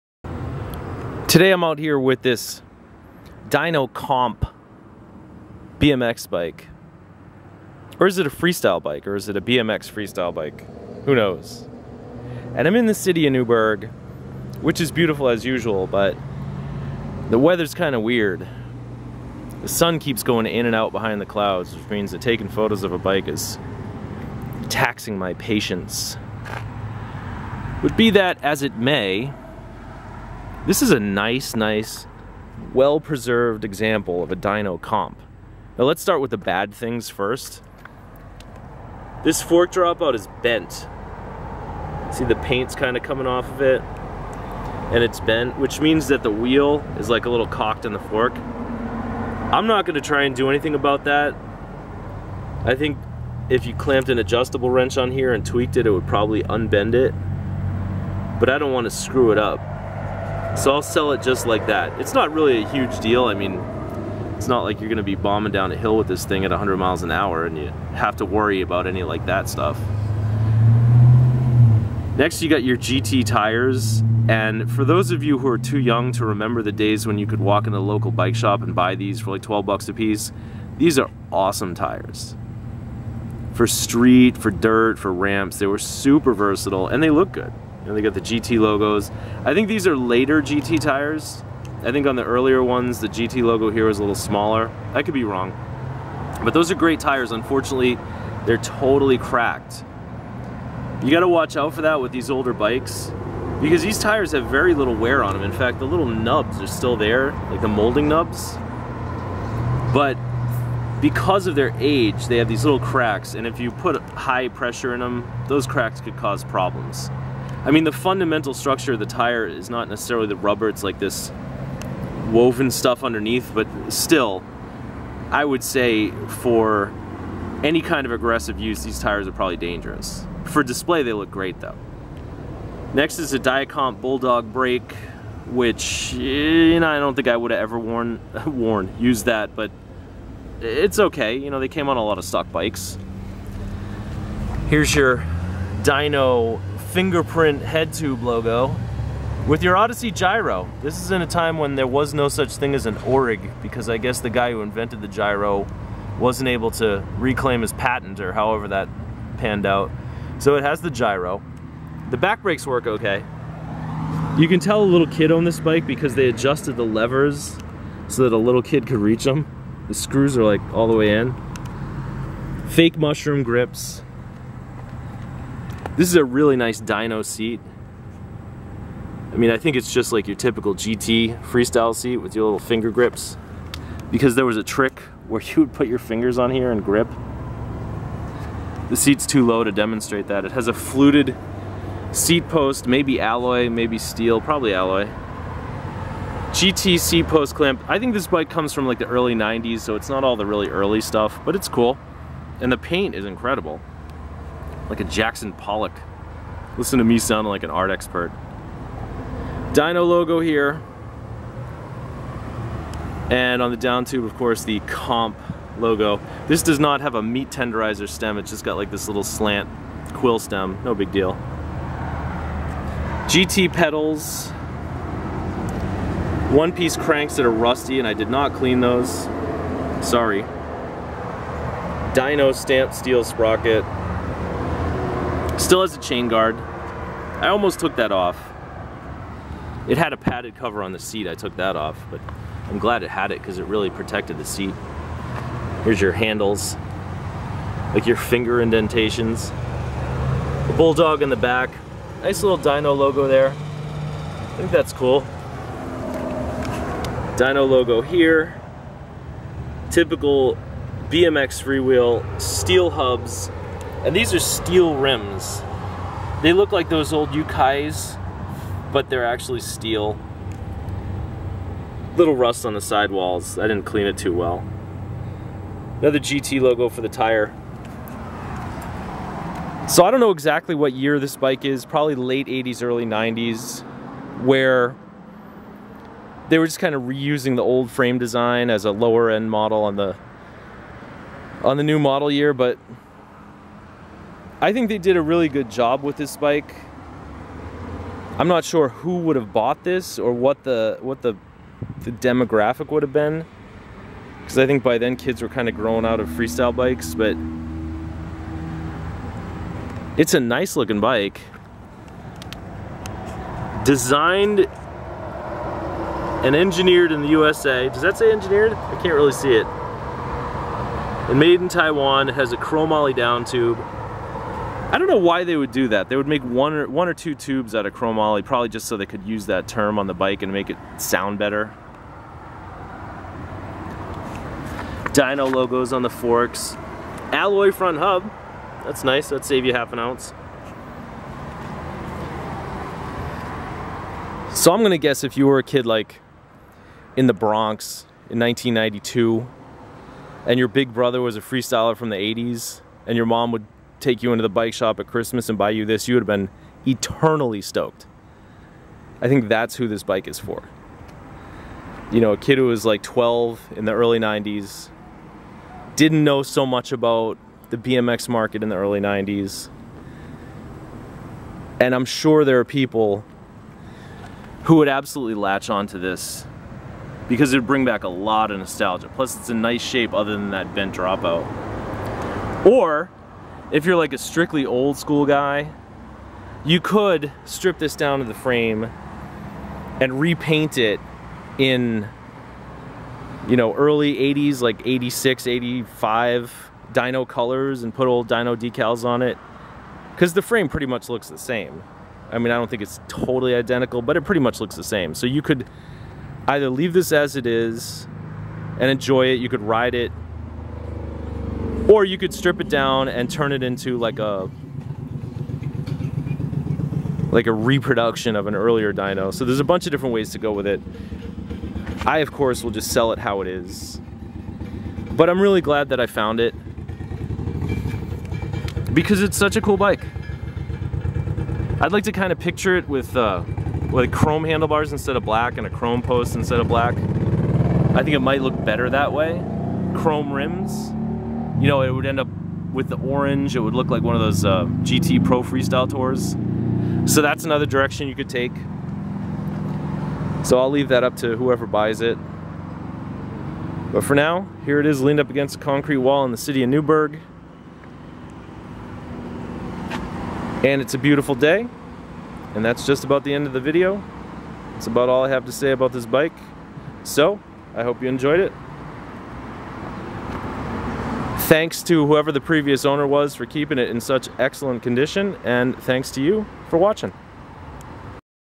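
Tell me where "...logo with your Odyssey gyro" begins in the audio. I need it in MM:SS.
02:28.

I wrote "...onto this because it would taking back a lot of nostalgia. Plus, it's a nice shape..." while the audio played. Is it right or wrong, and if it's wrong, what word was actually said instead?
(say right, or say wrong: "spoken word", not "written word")
wrong: "bring", not "taking".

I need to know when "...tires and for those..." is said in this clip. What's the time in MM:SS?
01:13.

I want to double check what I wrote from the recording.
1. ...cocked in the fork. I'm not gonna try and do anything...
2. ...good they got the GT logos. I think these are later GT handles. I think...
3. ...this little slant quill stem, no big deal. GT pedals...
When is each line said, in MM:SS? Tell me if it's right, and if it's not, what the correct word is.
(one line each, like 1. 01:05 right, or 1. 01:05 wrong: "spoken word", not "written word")
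1. 00:47 right
2. 01:27 wrong: "tires", not "handles"
3. 03:38 right.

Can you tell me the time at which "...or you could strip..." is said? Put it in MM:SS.
06:51.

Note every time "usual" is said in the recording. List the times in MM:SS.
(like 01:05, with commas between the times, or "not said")
00:15.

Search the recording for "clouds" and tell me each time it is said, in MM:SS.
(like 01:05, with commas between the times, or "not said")
00:21.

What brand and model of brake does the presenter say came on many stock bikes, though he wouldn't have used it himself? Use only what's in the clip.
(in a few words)
Dia-Compe Bulldog.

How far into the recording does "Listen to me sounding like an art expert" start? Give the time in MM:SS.
03:26.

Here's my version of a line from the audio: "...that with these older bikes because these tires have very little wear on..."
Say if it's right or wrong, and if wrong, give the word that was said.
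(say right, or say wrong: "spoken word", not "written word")
right.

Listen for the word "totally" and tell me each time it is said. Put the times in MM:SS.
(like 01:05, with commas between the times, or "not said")
01:38, 06:43.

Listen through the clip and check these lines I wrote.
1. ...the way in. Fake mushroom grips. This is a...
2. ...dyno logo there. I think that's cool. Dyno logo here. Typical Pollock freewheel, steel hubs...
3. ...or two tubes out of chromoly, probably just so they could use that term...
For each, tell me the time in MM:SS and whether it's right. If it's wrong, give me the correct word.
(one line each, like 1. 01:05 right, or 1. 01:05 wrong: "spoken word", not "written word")
1. 02:50 right
2. 04:12 wrong: "BMX", not "Pollock"
3. 05:27 right.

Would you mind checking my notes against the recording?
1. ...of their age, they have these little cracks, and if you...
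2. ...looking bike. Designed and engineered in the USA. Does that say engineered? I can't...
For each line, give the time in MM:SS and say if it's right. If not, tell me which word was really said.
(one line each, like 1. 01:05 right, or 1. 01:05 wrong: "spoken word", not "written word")
1. 01:51 right
2. 05:10 right.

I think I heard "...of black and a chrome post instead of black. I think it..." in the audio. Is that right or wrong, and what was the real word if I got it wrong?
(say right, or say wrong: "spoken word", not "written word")
right.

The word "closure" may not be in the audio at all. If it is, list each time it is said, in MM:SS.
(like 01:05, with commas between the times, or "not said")
not said.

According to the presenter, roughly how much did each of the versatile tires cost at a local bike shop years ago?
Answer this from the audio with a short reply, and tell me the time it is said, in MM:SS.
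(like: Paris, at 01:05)
12 bucks, at 01:19.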